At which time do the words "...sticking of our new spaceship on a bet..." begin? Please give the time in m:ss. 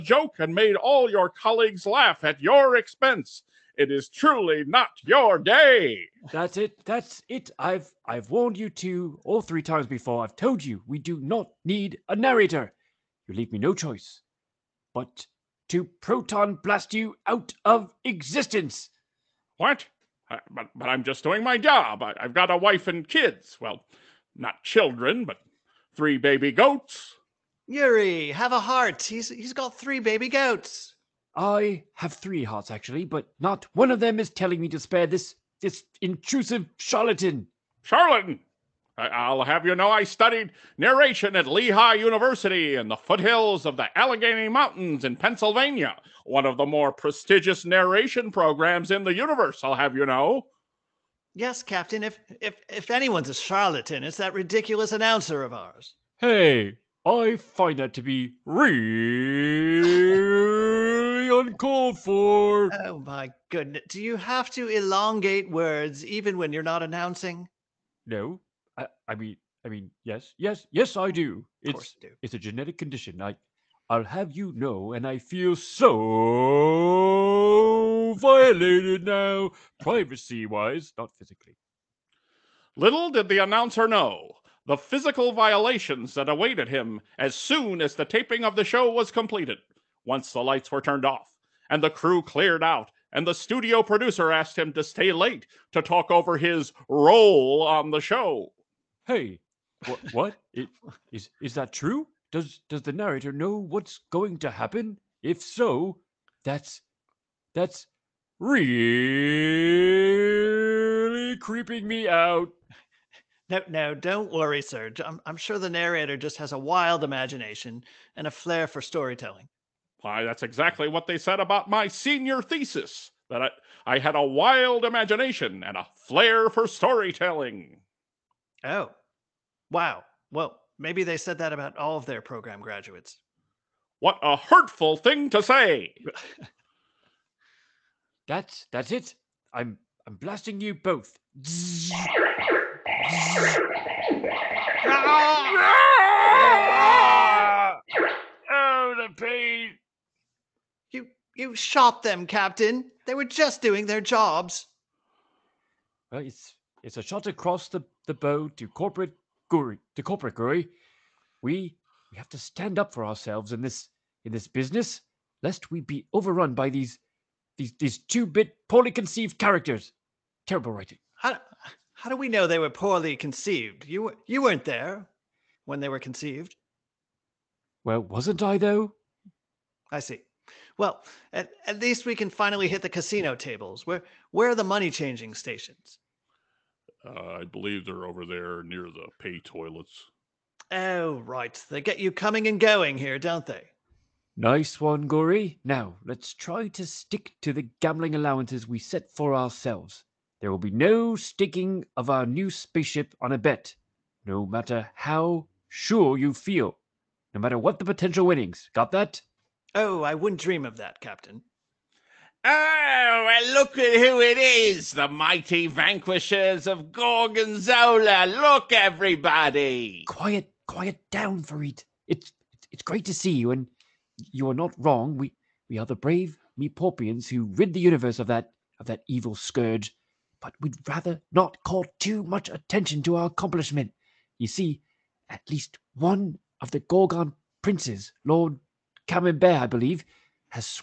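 3:21.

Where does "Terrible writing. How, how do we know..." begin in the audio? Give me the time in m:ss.
2:50.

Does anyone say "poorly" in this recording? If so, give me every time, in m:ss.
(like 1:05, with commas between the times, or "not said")
2:48, 2:52.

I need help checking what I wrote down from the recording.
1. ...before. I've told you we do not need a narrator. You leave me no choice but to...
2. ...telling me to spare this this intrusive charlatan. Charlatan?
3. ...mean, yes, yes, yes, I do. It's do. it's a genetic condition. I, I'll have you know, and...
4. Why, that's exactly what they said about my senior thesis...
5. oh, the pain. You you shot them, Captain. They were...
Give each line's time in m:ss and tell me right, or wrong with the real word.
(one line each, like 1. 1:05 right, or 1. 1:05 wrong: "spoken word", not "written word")
1. 0:09 right
2. 0:34 right
3. 1:09 right
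4. 2:00 right
5. 2:28 right.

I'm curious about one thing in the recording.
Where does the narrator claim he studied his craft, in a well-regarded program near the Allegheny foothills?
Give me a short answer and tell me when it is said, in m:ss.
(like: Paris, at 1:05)
Lehigh University, at 0:41.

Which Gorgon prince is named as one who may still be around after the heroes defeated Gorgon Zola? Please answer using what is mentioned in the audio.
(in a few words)
Lord Camembert.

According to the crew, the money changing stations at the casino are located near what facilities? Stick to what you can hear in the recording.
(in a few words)
Pay toilets.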